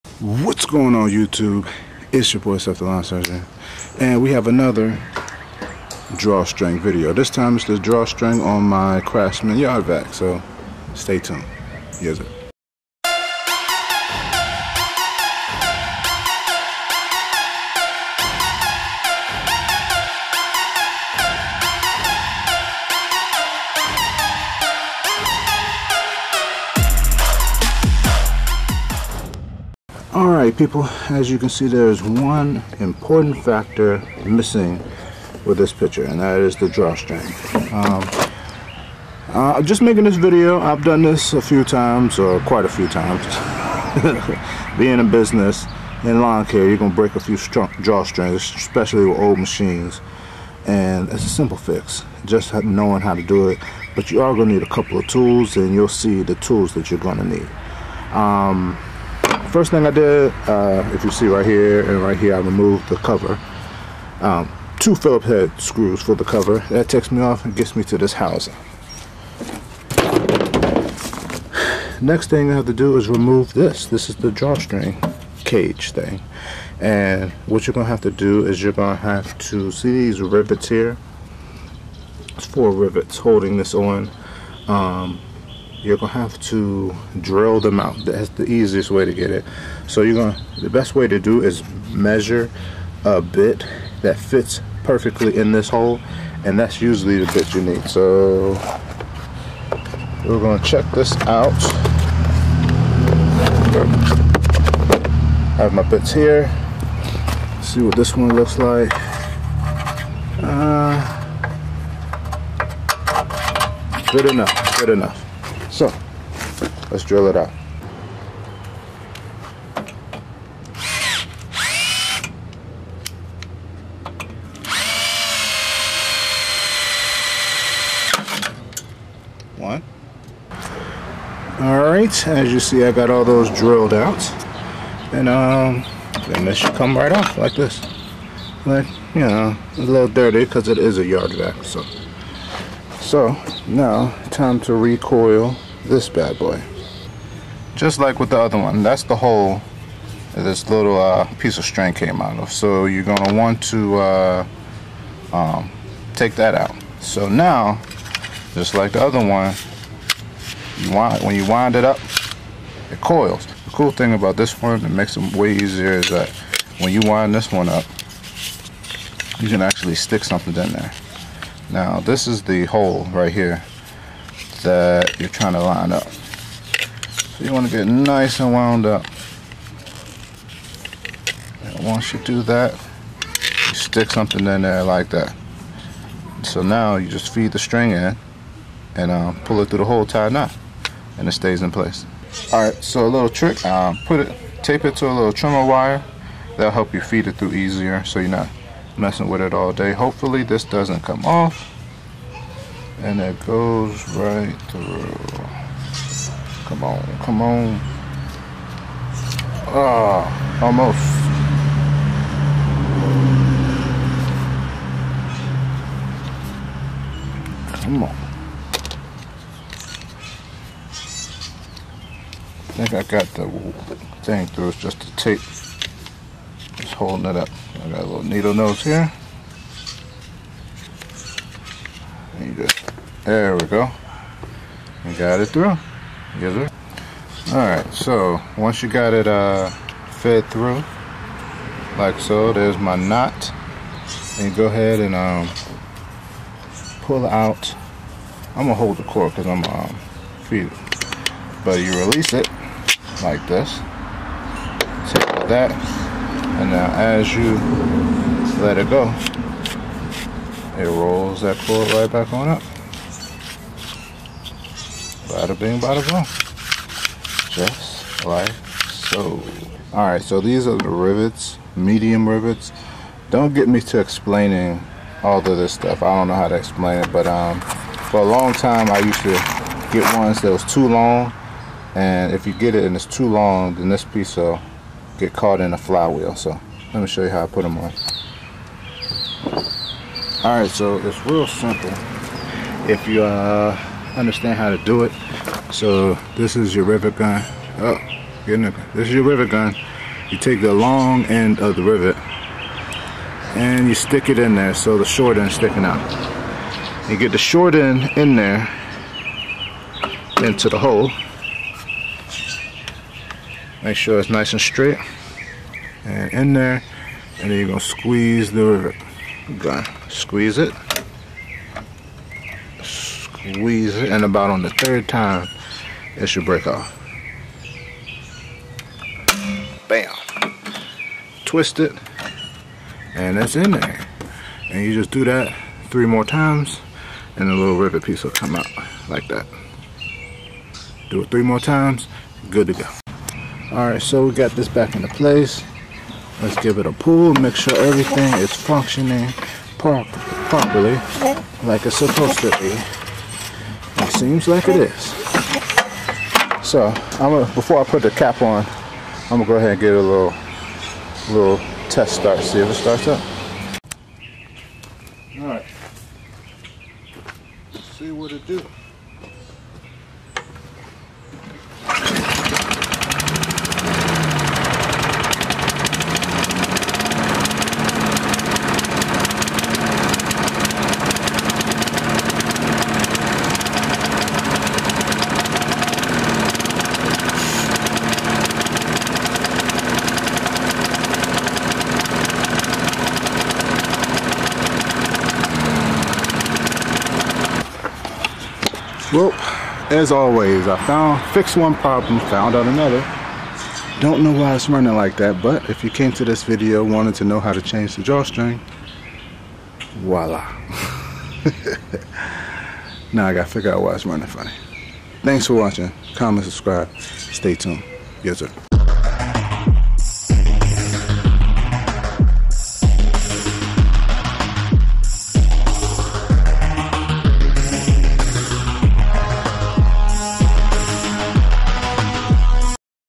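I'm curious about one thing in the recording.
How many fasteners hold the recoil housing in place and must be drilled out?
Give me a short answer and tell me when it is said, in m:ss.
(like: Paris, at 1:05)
4, at 1:22.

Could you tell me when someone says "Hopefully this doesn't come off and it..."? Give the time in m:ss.
3:19.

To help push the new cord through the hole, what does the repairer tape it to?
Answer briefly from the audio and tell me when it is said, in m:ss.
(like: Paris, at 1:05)
trimmer wire, at 3:15.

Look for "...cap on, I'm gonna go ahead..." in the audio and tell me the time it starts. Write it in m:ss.
5:58.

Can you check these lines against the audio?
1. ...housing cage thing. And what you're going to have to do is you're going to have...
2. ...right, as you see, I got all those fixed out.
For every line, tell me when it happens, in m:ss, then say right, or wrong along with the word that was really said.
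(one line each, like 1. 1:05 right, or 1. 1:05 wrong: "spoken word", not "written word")
1. 1:14 wrong: "drawstring", not "housing"
2. 2:11 wrong: "drilled", not "fixed".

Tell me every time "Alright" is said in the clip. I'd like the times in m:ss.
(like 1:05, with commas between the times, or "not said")
0:30, 3:57.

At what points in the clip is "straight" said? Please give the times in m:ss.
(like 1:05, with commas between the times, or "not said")
5:14.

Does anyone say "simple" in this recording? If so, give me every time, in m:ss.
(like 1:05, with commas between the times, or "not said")
0:51, 4:51.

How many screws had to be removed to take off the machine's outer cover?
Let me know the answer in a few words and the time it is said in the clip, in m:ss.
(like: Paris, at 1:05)
2, at 1:04.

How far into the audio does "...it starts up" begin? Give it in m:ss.
6:02.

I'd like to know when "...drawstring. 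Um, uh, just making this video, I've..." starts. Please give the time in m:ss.
0:36.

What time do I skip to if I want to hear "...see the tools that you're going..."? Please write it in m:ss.
0:55.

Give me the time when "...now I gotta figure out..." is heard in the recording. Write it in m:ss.
6:53.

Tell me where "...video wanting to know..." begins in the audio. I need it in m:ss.
6:46.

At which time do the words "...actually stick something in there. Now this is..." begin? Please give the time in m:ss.
2:49.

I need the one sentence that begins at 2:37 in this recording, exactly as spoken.
So now, just like the other one, you wind, when you wind it up, it coils.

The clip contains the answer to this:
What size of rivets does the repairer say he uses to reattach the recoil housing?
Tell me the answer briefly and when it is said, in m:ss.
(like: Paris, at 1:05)
medium, at 4:31.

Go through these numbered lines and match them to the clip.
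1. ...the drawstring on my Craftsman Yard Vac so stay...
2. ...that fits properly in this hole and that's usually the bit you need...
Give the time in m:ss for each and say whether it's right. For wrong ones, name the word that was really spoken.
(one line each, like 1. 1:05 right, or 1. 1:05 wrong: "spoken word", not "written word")
1. 0:07 right
2. 1:34 wrong: "perfectly", not "properly".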